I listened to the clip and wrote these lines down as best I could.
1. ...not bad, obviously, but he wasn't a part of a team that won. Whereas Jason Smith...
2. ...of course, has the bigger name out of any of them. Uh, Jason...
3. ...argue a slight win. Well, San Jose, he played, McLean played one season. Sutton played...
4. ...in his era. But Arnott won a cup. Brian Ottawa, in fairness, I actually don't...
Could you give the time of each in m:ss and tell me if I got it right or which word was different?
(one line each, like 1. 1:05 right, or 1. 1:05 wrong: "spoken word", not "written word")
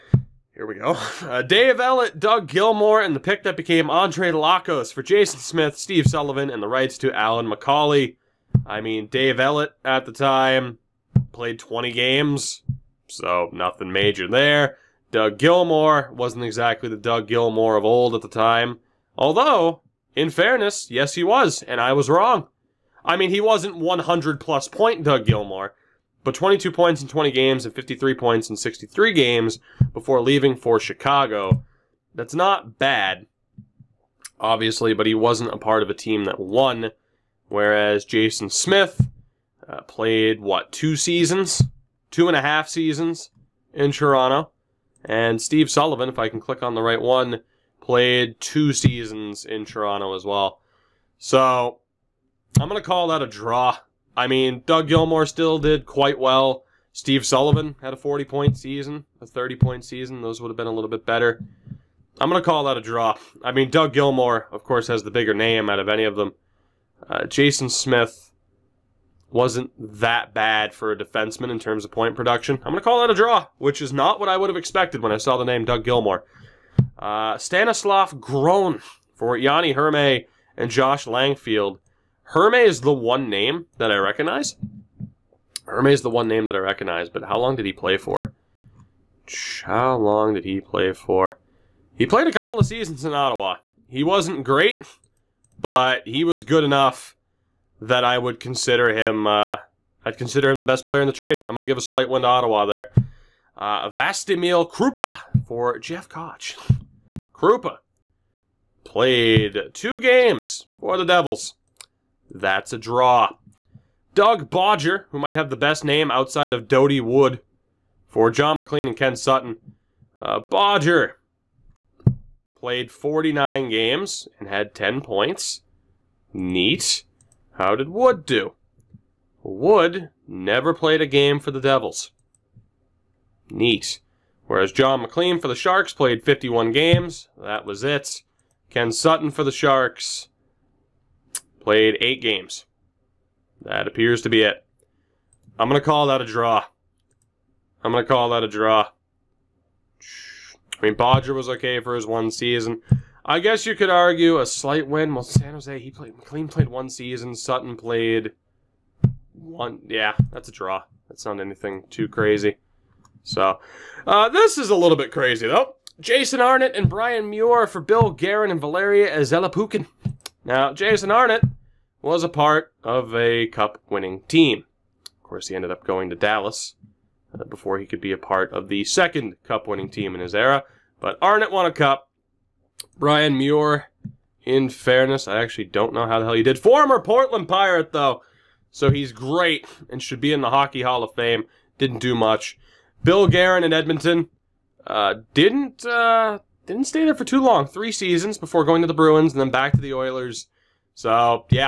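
1. 0:32 right
2. 1:04 right
3. 2:33 right
4. 3:00 wrong: "Muir", not "Ottawa".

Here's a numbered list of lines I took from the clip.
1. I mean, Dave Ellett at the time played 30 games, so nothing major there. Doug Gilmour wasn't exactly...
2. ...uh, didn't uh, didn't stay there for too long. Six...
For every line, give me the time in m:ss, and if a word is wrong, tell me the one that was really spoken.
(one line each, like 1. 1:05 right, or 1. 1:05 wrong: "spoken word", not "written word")
1. 0:08 wrong: "20", not "30"
2. 3:14 wrong: "Three", not "Six".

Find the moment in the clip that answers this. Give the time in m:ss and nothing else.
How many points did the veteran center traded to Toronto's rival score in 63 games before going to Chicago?
0:27.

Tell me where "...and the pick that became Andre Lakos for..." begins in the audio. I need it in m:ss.
0:03.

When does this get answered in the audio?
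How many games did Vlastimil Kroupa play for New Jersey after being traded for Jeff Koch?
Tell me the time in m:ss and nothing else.
1:49.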